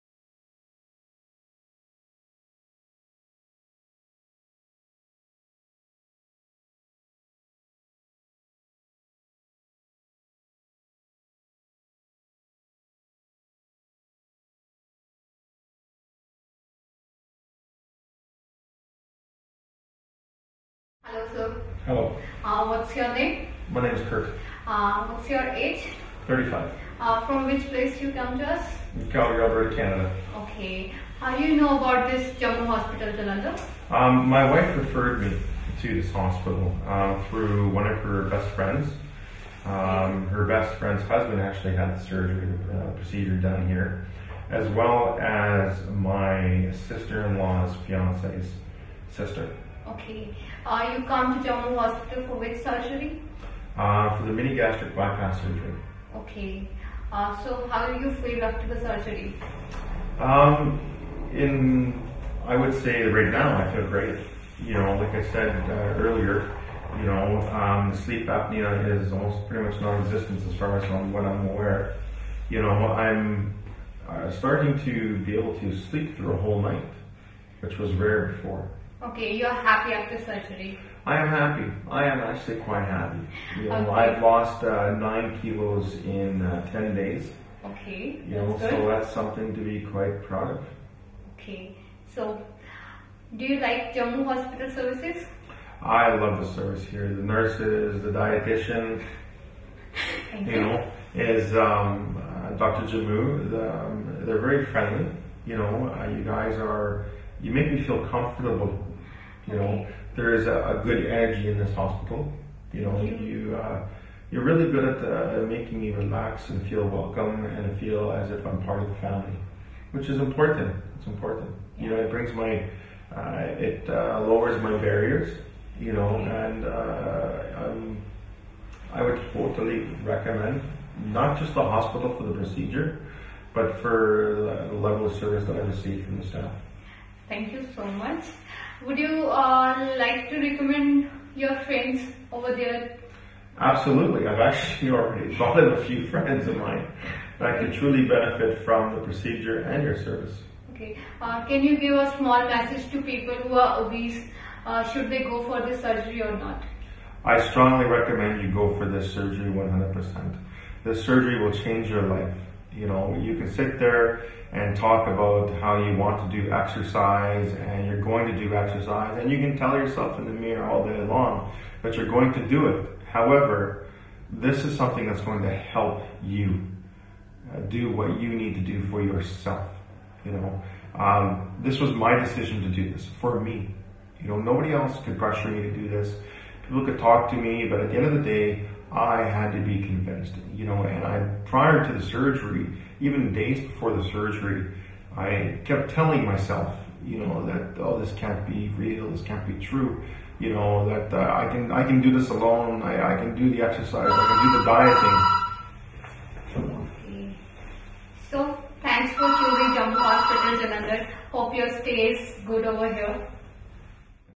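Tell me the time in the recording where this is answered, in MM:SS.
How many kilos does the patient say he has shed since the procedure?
01:24.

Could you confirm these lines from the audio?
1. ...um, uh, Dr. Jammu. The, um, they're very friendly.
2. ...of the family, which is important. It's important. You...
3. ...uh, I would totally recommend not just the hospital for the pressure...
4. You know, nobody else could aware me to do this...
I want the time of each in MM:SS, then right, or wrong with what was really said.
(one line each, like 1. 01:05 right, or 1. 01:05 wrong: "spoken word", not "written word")
1. 01:41 right
2. 01:58 right
3. 02:06 wrong: "procedure", not "pressure"
4. 03:04 wrong: "pressure", not "aware".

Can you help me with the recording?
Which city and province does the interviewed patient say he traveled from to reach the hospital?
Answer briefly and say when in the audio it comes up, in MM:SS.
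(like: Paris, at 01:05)
Calgary, Alberta, at 00:29.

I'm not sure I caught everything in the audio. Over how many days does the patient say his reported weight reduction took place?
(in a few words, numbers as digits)
10.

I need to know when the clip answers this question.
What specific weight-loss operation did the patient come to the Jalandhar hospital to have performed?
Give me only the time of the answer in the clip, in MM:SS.
00:54.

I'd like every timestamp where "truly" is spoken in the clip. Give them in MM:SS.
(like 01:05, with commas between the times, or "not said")
02:27.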